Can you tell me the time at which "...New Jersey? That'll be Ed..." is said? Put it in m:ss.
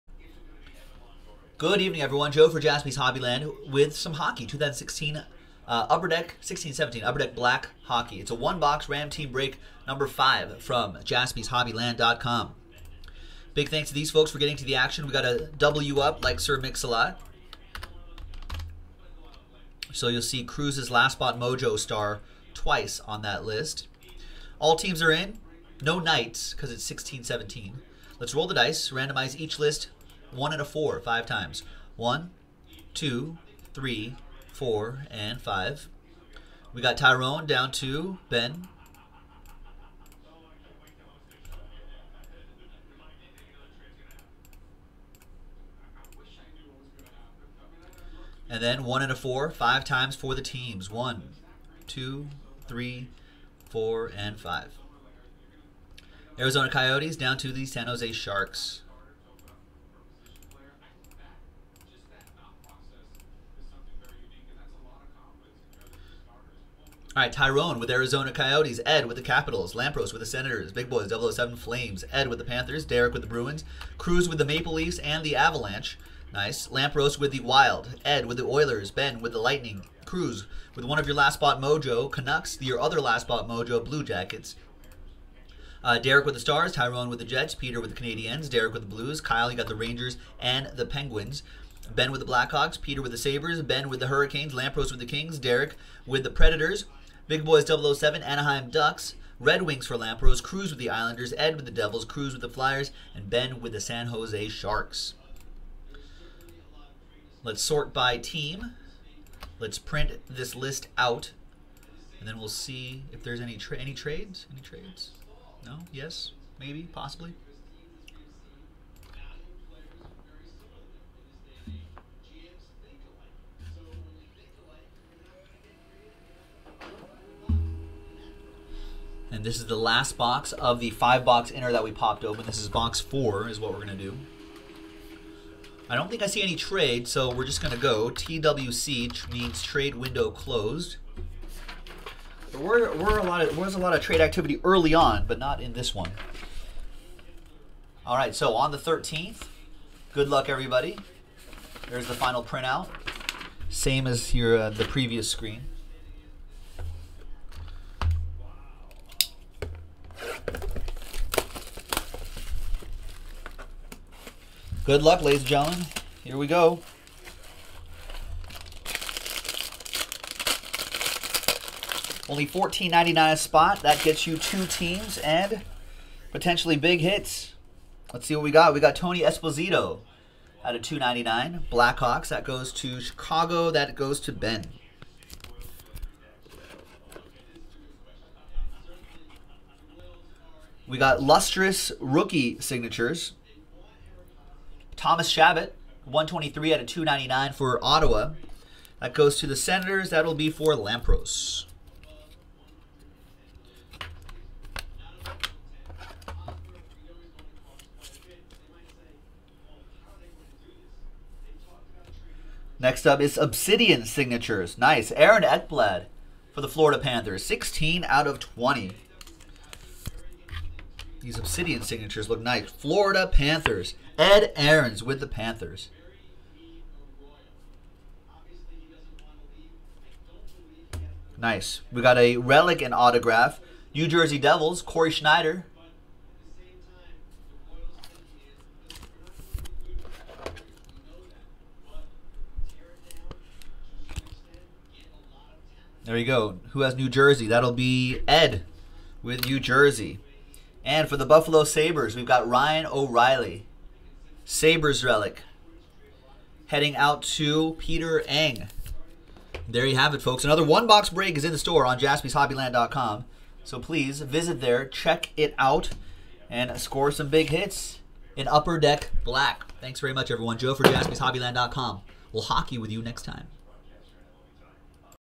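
4:06.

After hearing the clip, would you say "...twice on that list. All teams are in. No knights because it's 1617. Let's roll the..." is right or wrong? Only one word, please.
right.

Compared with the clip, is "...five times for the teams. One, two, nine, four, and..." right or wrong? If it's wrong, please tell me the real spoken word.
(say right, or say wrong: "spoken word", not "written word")
wrong: "three", not "nine".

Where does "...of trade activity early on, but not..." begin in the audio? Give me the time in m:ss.
2:23.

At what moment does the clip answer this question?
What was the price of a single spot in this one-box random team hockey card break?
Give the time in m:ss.
2:52.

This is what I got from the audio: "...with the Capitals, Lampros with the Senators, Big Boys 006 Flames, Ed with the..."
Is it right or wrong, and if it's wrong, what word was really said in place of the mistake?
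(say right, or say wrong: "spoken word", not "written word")
wrong: "007", not "006".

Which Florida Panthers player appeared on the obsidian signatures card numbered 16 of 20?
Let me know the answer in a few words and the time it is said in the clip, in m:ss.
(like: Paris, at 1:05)
Aaron Ekblad, at 3:35.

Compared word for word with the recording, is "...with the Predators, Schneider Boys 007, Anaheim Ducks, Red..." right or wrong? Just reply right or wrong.
wrong.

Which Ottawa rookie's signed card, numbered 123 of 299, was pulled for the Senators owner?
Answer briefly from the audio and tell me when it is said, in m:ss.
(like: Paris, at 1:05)
Thomas Chabot, at 3:15.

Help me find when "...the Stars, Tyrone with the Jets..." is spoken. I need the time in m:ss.
1:26.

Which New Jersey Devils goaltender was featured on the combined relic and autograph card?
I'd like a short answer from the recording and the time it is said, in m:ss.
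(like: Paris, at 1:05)
Cory Schneider, at 3:54.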